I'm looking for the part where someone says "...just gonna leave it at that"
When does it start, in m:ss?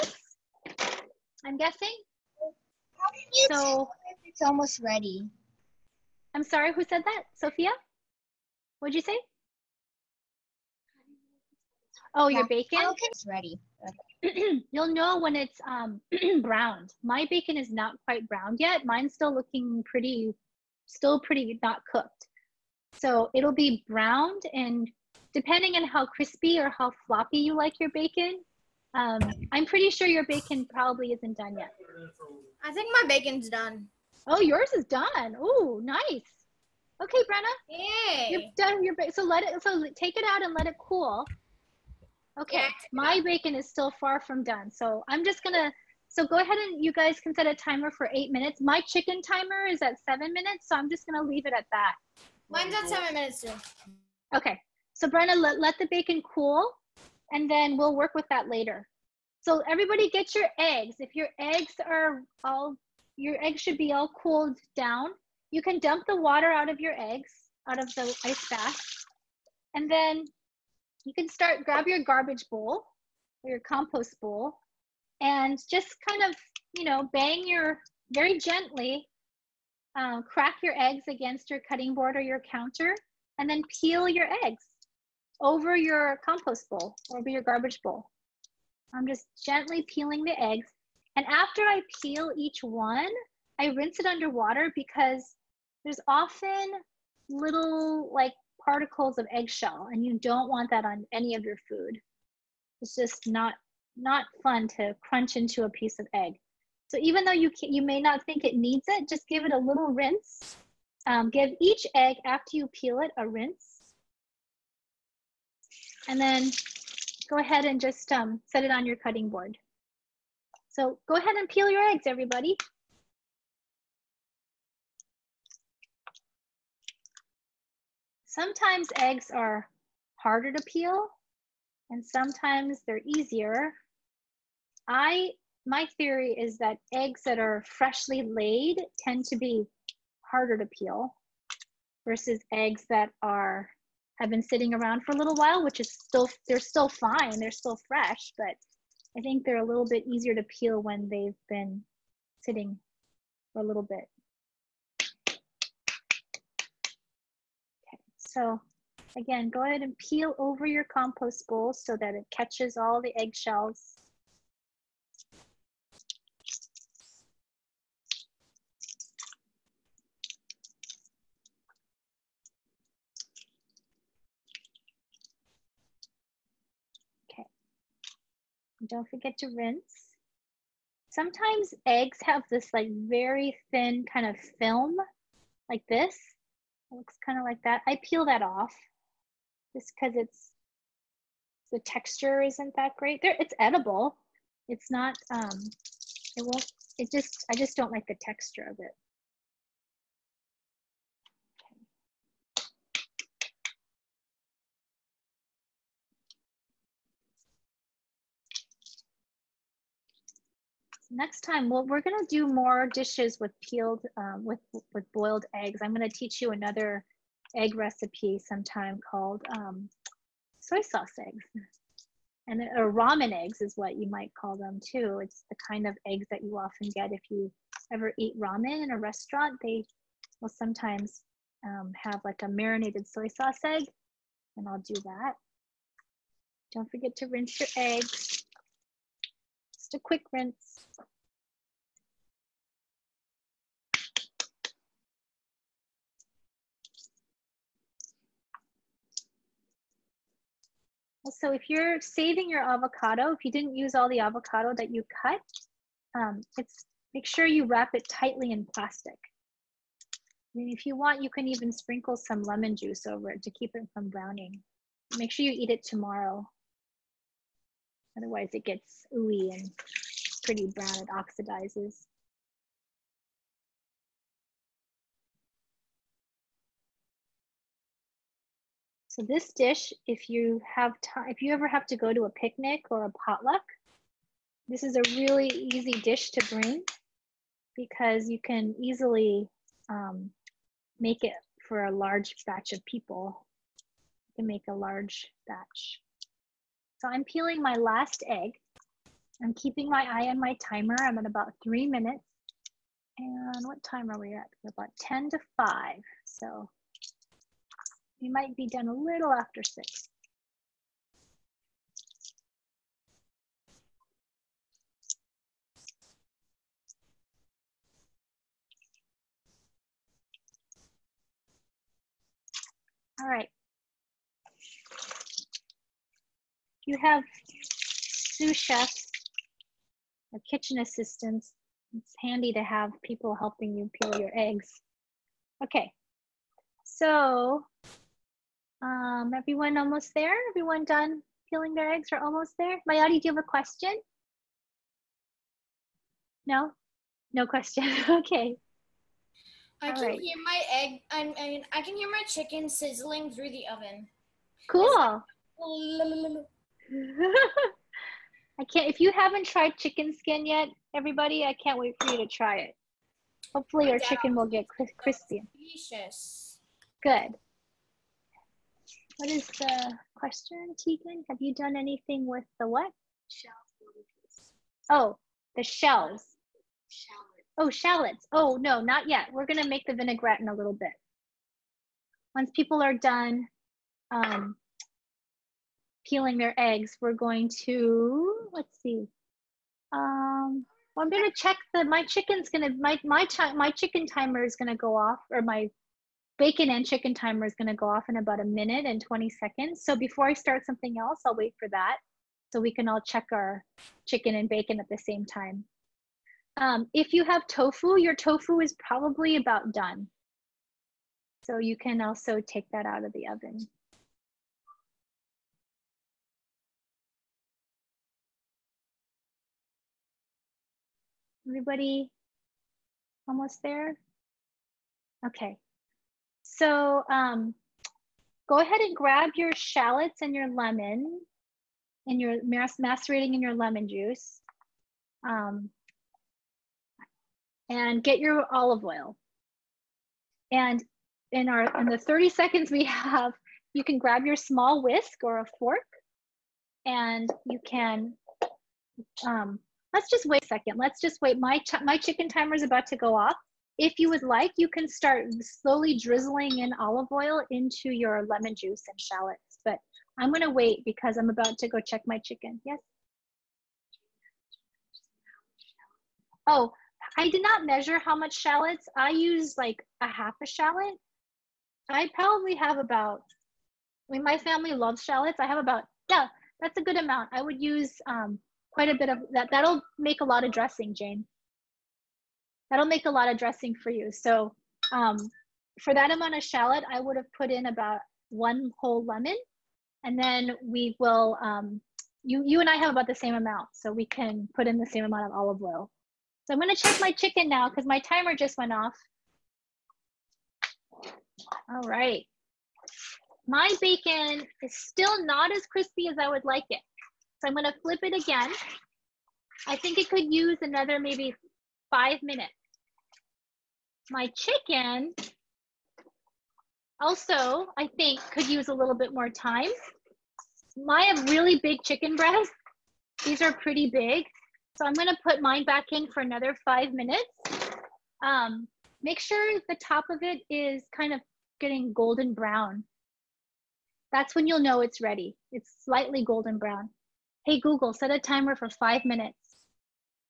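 0:50.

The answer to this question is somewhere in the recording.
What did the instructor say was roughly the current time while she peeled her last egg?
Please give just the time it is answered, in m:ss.
5:05.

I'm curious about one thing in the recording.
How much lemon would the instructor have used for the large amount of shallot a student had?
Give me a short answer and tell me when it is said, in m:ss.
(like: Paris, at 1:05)
1 whole lemon, at 8:08.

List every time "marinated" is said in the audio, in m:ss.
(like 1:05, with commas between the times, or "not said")
3:52.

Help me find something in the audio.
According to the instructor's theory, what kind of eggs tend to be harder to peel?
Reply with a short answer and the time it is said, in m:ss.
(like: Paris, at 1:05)
freshly laid, at 2:17.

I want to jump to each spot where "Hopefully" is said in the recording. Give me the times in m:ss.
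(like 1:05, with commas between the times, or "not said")
6:03.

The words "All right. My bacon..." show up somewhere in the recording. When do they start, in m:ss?
8:21.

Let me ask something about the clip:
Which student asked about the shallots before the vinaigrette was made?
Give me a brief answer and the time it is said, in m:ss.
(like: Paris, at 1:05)
Tegan, at 6:10.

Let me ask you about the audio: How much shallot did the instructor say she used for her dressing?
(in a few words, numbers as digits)
half a shallot.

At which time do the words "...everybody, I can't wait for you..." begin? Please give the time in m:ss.
6:00.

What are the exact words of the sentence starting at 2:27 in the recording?
They're still fresh, but I think they're a little bit easier to peel when they've been sitting for a little bit.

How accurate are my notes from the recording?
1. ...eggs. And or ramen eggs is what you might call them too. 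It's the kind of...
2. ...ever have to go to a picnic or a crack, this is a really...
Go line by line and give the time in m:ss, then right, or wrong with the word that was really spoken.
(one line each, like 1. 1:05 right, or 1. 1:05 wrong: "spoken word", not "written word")
1. 3:41 right
2. 4:41 wrong: "potluck", not "crack".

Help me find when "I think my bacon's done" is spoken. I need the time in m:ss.
0:32.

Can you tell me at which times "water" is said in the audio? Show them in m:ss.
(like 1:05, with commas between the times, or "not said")
1:06, 1:34.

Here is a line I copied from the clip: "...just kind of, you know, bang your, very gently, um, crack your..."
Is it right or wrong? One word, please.
right.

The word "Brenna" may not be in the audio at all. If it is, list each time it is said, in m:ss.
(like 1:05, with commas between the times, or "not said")
0:37, 0:55.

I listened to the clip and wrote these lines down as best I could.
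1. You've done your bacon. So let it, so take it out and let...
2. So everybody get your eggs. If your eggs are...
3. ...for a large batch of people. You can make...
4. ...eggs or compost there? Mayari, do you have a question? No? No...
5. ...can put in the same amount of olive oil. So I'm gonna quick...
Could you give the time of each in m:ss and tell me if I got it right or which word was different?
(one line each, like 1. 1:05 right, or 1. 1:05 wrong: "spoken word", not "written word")
1. 0:38 right
2. 0:59 right
3. 4:51 right
4. 5:41 wrong: "almost", not "compost"
5. 8:14 wrong: "check", not "quick".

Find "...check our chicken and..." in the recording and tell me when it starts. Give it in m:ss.
6:43.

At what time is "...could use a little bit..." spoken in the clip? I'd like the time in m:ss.
8:38.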